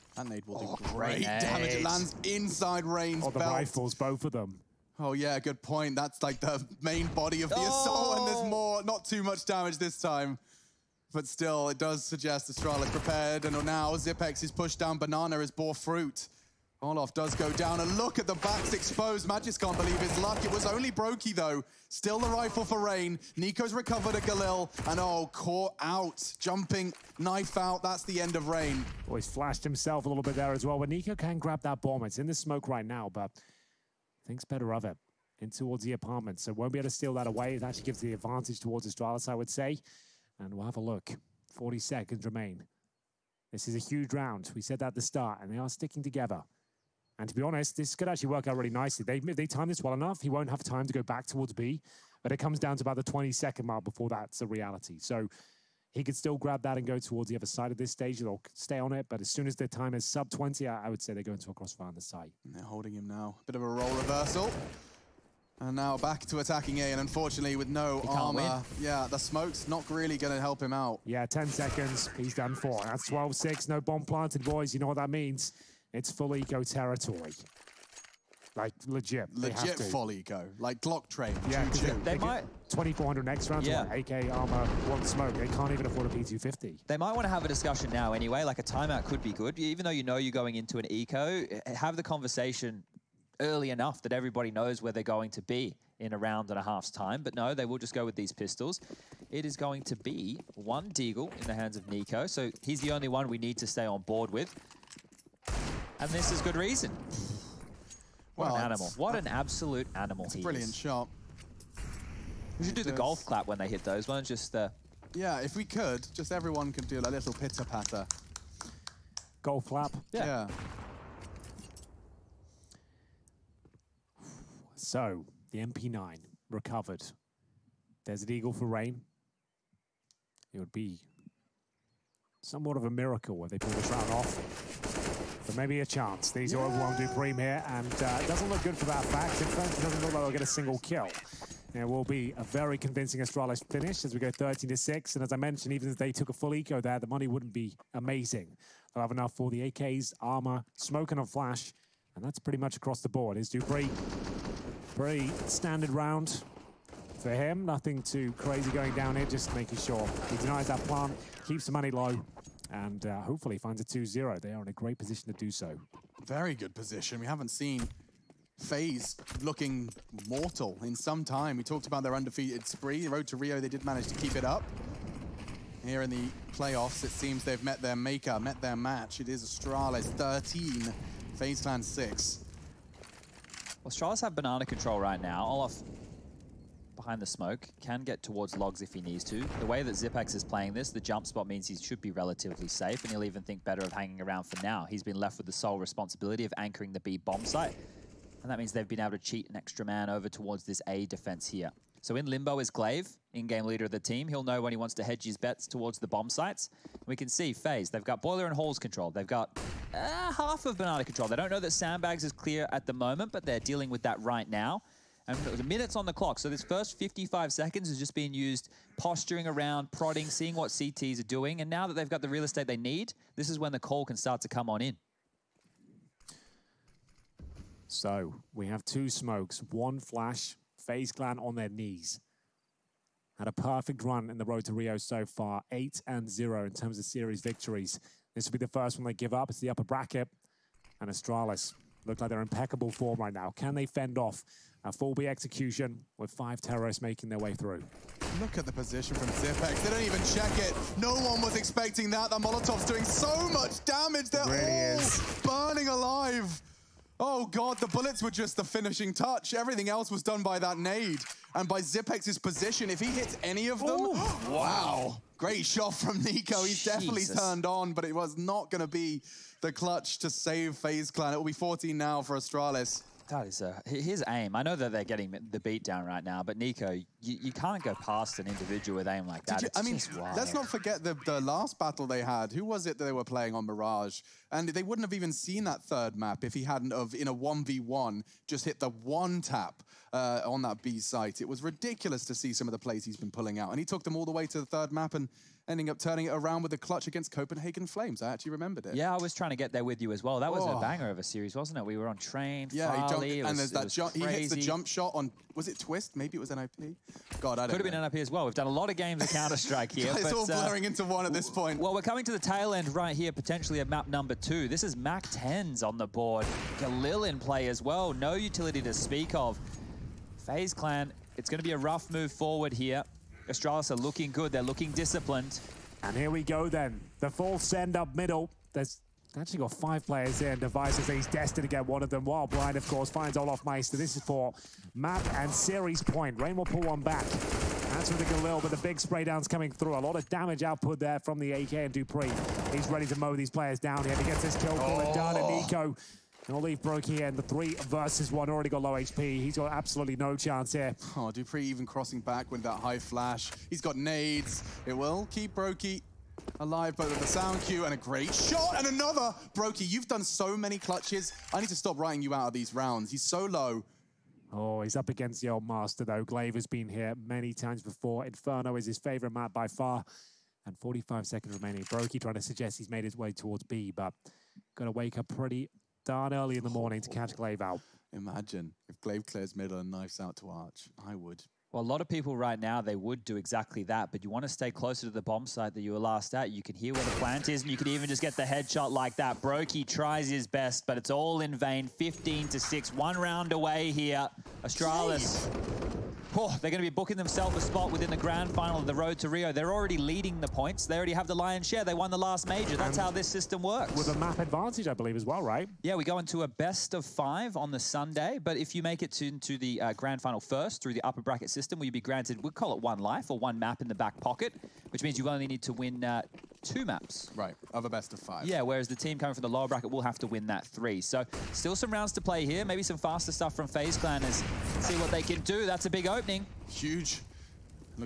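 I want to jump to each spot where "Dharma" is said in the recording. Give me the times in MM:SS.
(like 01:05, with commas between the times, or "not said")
not said.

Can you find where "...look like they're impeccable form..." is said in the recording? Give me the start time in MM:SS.
04:02.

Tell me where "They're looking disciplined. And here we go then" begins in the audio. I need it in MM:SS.
05:24.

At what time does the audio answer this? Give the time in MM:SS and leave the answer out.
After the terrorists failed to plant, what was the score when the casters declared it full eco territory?
01:13.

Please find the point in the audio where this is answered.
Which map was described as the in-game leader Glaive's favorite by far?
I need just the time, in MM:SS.
06:08.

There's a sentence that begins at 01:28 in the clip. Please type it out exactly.
Like a timeout could be good.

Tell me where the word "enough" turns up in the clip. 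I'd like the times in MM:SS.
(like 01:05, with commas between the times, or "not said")
00:49, 01:33, 02:29.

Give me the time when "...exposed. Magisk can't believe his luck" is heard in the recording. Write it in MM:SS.
00:18.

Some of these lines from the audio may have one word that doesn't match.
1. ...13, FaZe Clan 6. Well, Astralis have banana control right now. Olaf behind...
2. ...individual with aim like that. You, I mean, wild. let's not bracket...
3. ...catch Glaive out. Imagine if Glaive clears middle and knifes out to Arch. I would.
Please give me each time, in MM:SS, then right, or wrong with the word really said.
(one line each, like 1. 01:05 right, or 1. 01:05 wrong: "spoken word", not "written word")
1. 03:00 right
2. 04:38 wrong: "forget", not "bracket"
3. 06:17 right.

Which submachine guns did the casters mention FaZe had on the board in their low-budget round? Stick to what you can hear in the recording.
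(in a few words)
Mac 10s.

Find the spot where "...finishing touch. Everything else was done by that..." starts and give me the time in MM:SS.
04:18.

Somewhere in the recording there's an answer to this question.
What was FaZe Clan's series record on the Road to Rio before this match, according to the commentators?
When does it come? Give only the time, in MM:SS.
03:55.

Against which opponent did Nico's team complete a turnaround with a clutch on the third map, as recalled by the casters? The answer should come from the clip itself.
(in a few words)
Copenhagen Flames.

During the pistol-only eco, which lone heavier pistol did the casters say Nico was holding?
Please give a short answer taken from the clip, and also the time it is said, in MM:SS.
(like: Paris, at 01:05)
Deagle, at 01:40.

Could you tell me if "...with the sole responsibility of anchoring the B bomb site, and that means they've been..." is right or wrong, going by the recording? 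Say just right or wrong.
right.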